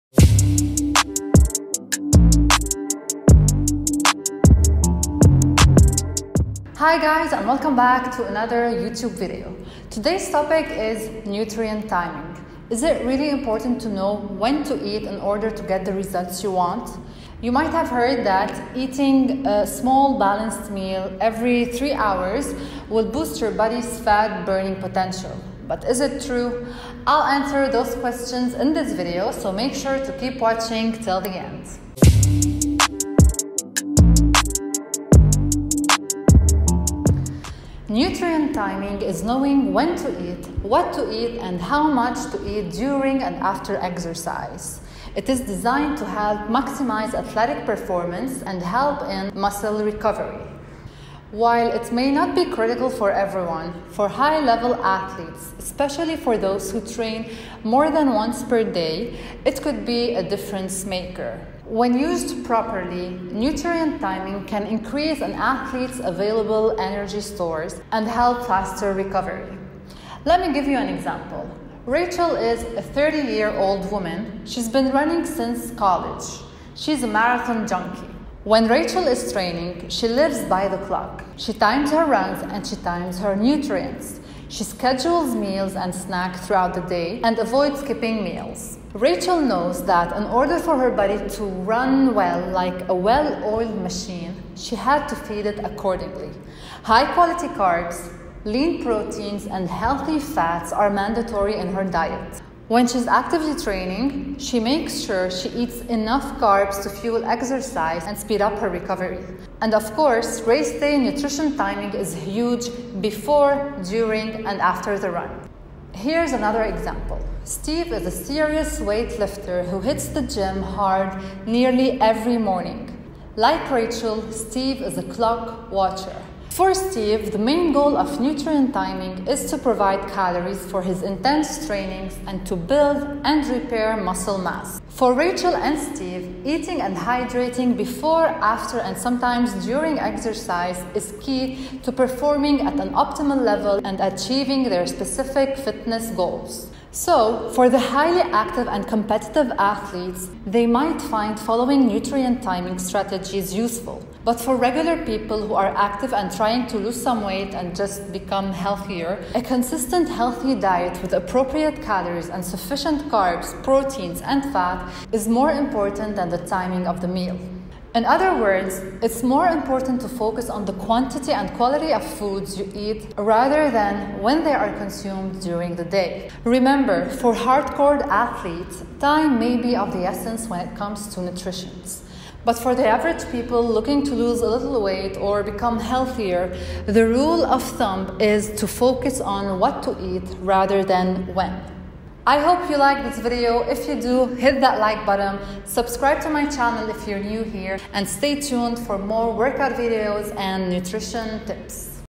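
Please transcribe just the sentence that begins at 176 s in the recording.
Remember, for hardcore athletes, time may be of the essence when it comes to nutrition.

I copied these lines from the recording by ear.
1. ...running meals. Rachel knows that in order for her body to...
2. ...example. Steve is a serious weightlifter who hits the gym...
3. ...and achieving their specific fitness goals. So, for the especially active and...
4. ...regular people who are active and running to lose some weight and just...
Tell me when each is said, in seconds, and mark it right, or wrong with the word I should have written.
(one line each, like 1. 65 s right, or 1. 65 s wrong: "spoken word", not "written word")
1. 87 s wrong: "skipping", not "running"
2. 116 s right
3. 143 s wrong: "highly", not "especially"
4. 154 s wrong: "trying", not "running".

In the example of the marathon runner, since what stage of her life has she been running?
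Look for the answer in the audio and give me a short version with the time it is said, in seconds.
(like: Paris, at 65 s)
college, at 75 s.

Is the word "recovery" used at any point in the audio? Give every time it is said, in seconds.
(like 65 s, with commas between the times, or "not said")
49 s, 68 s, 108 s.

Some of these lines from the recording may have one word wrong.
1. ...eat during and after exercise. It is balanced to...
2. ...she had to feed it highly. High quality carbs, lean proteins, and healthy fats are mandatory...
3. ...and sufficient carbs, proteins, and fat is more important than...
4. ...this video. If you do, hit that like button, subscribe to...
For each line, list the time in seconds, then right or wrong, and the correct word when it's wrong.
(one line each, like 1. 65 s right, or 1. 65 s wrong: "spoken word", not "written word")
1. 42 s wrong: "designed", not "balanced"
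2. 94 s wrong: "accordingly", not "highly"
3. 162 s right
4. 193 s right.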